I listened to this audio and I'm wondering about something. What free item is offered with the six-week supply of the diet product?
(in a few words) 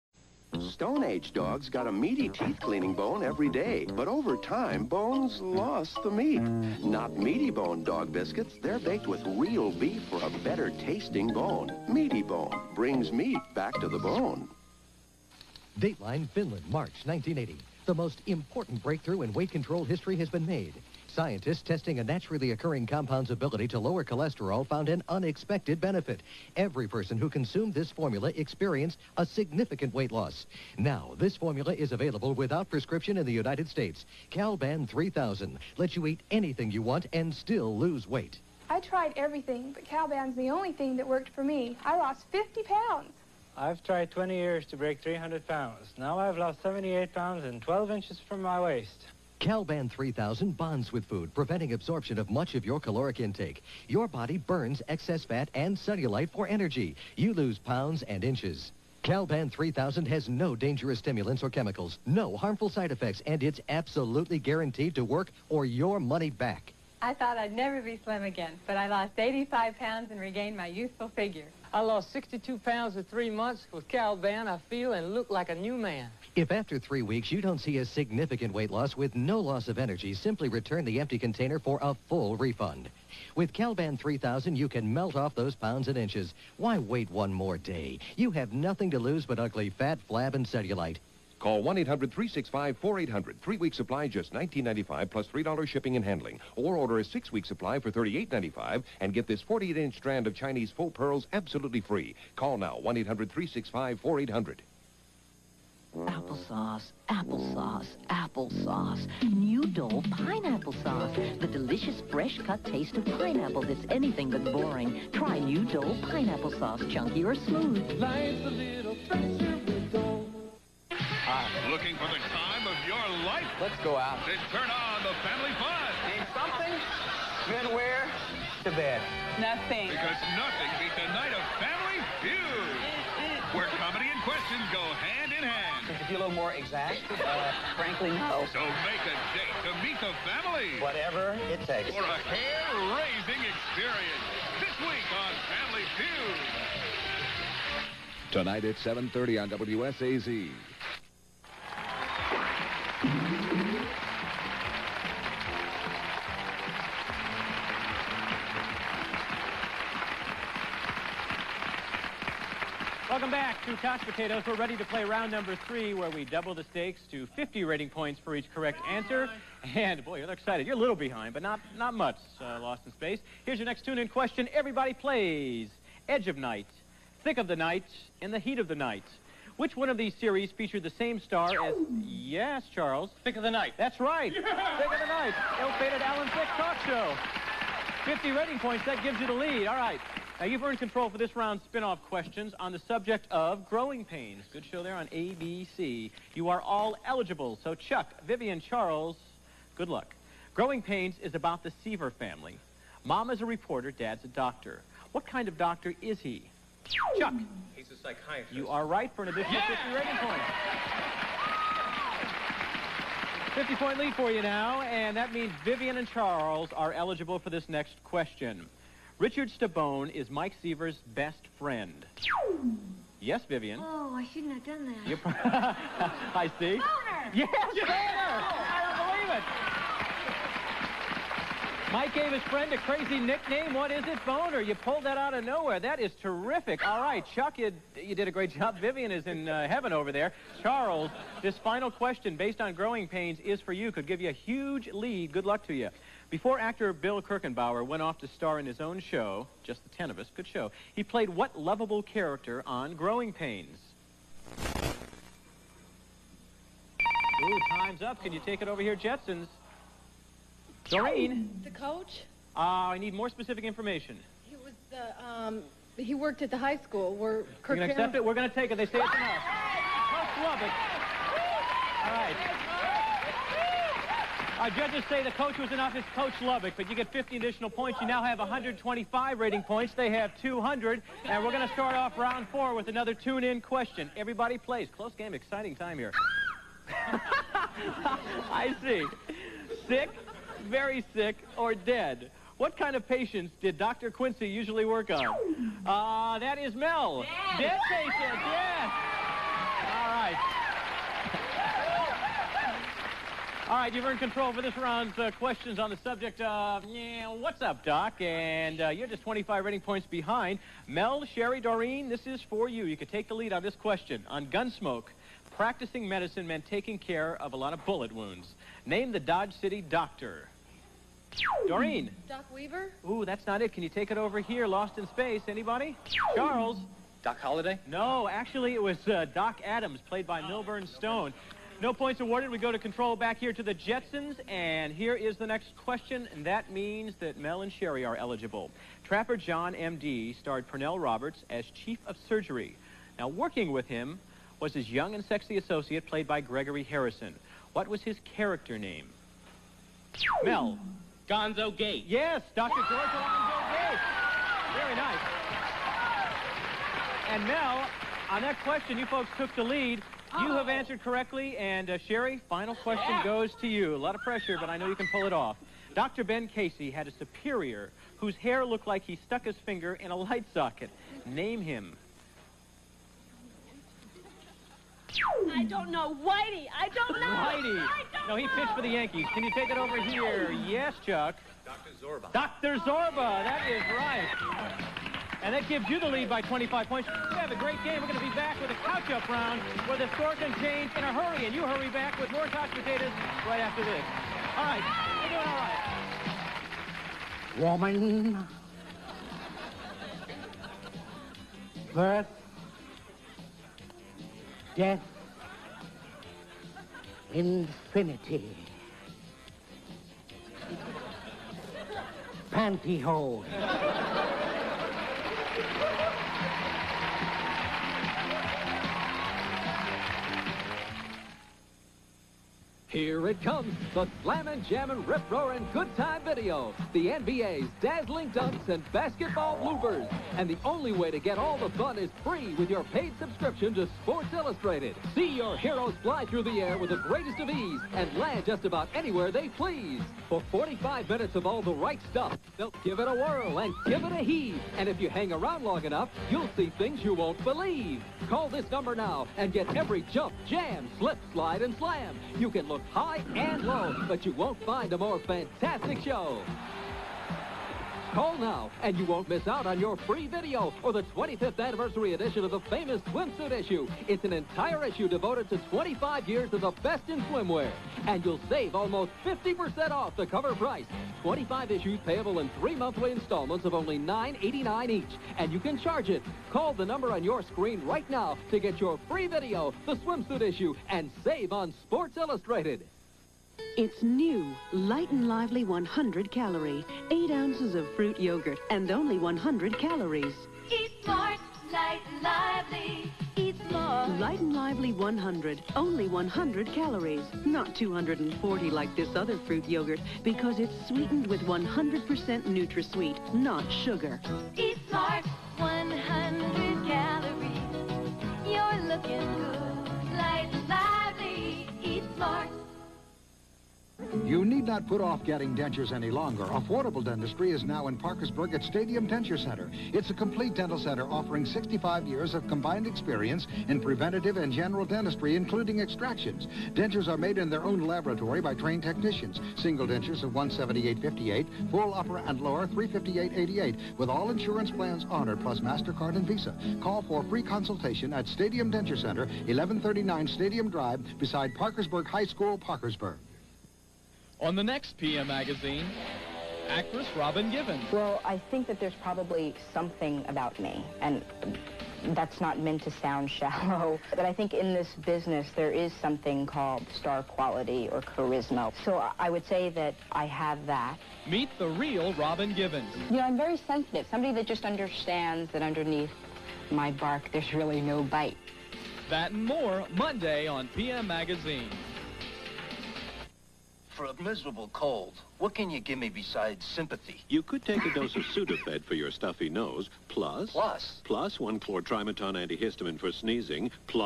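Chinese faux pearls.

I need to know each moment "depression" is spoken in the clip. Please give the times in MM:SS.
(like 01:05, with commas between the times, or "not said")
not said.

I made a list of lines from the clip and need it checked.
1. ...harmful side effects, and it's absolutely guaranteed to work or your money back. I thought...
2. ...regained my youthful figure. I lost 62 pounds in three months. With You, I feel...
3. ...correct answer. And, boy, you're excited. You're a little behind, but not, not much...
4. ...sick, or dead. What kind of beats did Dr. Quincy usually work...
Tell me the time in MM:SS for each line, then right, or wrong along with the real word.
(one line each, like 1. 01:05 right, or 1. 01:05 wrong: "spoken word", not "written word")
1. 01:02 right
2. 01:10 wrong: "Calban", not "You"
3. 02:48 right
4. 04:51 wrong: "patients", not "beats".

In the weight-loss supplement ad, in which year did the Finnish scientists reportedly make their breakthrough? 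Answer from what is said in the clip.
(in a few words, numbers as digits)
1980.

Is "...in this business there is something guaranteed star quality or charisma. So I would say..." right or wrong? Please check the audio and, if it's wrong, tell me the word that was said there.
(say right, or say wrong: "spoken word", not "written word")
wrong: "called", not "guaranteed".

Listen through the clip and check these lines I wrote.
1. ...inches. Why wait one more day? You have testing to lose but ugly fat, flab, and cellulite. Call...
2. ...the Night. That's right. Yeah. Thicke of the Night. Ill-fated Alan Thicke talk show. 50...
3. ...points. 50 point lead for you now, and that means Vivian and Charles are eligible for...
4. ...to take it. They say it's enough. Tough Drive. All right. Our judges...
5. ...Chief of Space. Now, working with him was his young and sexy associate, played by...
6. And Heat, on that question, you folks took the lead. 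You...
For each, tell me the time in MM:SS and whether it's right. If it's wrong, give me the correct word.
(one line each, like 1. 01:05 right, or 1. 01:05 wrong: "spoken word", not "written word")
1. 01:25 wrong: "nothing", not "testing"
2. 03:03 right
3. 03:33 right
4. 04:28 wrong: "Lubbock", not "Drive"
5. 05:41 wrong: "Surgery", not "Space"
6. 05:57 wrong: "Mel", not "Heat".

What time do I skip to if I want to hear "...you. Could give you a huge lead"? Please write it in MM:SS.
04:03.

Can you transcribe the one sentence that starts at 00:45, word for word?
Now I've lost 78 pounds and 12 inches from my waist.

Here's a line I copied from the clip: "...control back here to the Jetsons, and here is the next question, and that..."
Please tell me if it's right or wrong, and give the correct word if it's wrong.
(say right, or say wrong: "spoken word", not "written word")
right.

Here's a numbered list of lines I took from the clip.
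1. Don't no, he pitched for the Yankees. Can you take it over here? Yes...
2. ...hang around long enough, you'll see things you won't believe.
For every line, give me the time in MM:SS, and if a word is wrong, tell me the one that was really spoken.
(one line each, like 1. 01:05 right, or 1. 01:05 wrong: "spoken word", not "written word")
1. 06:18 right
2. 07:25 right.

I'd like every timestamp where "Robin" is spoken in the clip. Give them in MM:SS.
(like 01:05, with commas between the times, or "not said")
09:07, 09:22.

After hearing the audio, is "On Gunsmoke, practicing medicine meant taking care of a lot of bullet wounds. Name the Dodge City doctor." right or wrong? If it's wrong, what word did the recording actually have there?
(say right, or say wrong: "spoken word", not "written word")
right.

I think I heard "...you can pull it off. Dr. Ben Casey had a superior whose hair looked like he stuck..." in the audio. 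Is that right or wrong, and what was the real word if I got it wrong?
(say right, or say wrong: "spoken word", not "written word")
right.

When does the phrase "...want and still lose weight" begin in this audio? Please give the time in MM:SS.
00:36.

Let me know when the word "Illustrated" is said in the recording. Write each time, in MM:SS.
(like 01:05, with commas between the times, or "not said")
07:14, 08:02.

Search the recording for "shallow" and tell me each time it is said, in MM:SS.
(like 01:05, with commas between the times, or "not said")
09:13.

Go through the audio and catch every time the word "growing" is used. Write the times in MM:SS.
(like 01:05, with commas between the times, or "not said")
03:13, 03:20, 04:02, 04:12.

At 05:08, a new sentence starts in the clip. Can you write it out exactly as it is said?
And uh, you're just 25 rating points behind.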